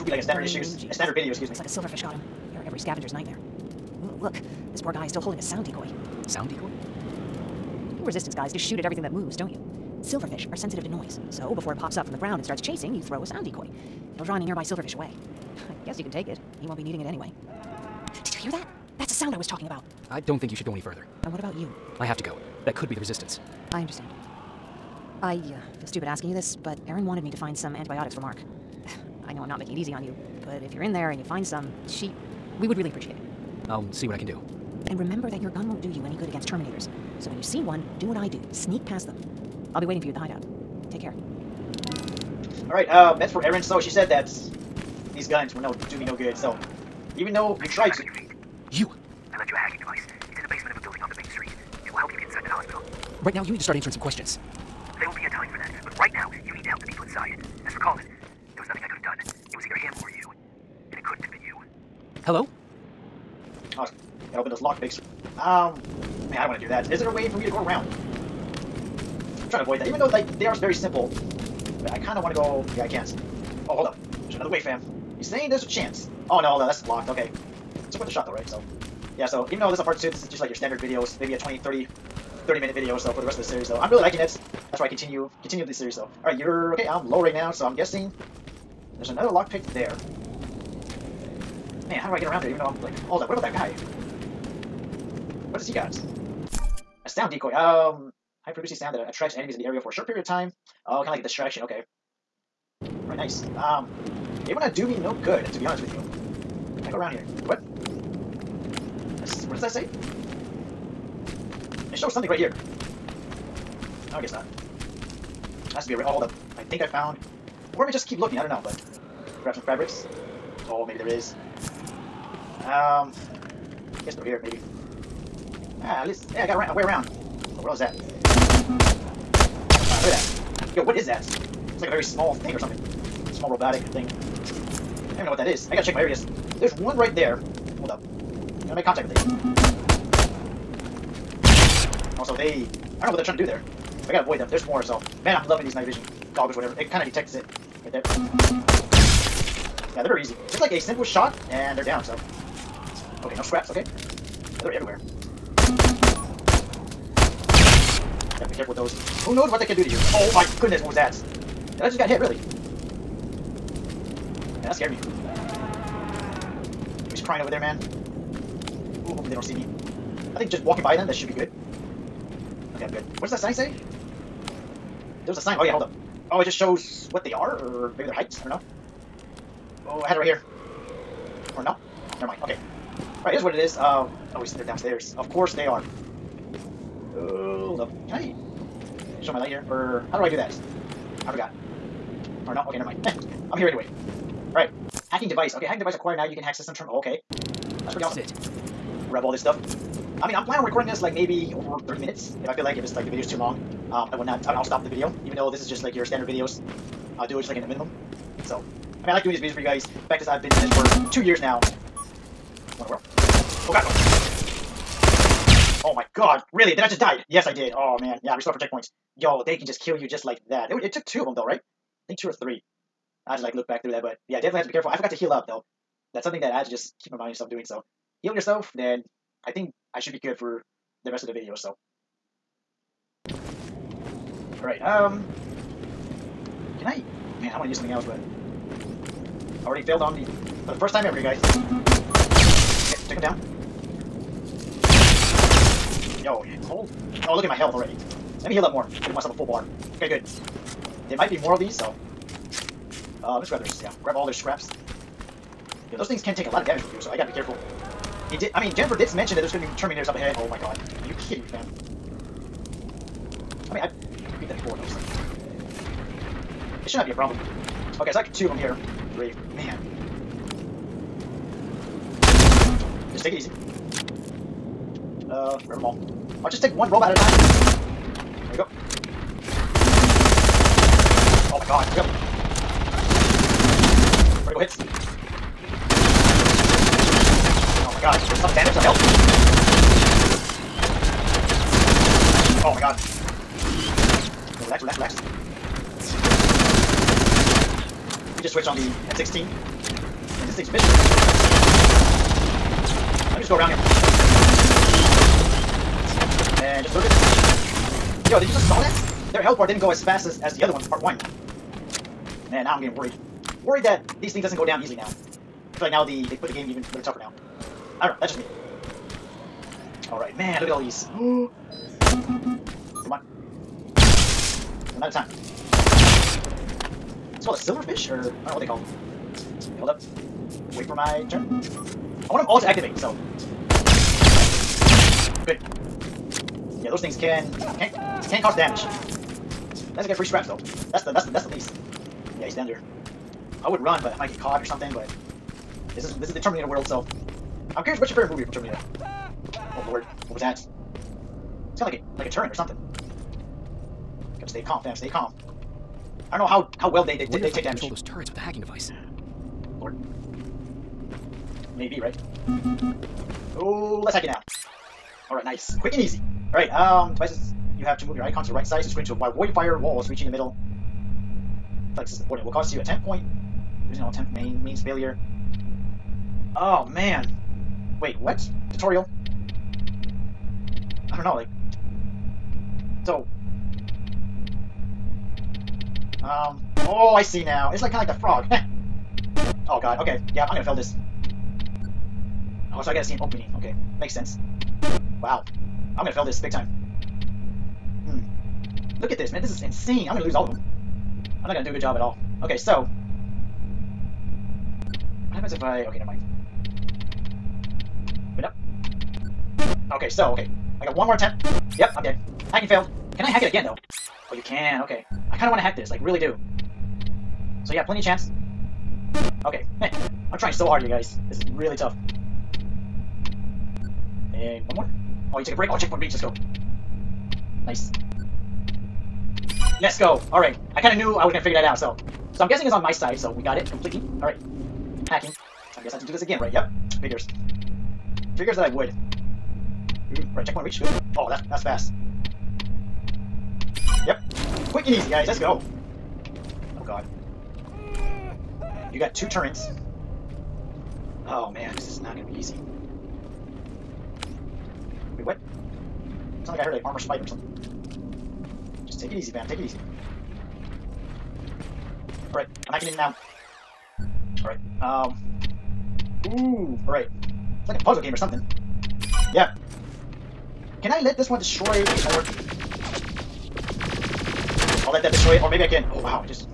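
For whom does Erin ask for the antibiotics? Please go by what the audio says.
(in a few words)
Mark.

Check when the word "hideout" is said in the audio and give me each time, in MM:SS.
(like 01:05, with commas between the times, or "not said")
00:40.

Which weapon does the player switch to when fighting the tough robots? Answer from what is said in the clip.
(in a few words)
M16.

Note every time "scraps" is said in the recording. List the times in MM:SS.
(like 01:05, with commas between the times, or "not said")
02:33, 04:14, 05:40.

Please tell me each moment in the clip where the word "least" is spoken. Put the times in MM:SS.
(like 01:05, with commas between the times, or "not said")
02:06, 05:41.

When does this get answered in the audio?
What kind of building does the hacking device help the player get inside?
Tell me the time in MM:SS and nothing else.
00:52.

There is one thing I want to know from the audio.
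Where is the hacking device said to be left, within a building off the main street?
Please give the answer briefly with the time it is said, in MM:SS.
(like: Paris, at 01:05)
The basement, at 00:50.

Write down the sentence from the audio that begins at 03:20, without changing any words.
I mean, I'm planning on recording this like maybe over 30 minutes.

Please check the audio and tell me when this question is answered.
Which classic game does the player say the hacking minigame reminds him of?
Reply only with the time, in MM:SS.
06:28.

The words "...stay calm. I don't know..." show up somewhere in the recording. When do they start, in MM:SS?
05:54.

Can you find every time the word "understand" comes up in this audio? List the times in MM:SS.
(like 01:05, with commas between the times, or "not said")
00:23.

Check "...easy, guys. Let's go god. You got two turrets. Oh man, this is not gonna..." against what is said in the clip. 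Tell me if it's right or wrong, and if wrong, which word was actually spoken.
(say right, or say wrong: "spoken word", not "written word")
right.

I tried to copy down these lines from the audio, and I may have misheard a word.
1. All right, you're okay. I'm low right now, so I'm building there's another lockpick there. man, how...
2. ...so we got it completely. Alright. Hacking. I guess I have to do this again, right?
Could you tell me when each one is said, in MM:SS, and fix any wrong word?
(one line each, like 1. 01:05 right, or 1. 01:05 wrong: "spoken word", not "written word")
1. 01:26 wrong: "guessing", not "building"
2. 07:13 right.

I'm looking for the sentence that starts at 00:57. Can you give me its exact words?
As for Colin, was either him or you.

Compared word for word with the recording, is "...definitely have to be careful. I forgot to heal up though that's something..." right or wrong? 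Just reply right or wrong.
right.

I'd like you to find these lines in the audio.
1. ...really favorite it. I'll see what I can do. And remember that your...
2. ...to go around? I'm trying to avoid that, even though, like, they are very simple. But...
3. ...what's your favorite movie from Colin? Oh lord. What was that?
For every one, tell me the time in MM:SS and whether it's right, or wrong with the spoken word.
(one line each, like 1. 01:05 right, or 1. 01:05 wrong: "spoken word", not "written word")
1. 00:32 wrong: "appreciate", not "favorite"
2. 01:07 right
3. 05:47 wrong: "Terminator", not "Colin".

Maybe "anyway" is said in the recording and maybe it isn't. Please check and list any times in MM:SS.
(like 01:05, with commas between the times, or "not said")
00:17, 03:13.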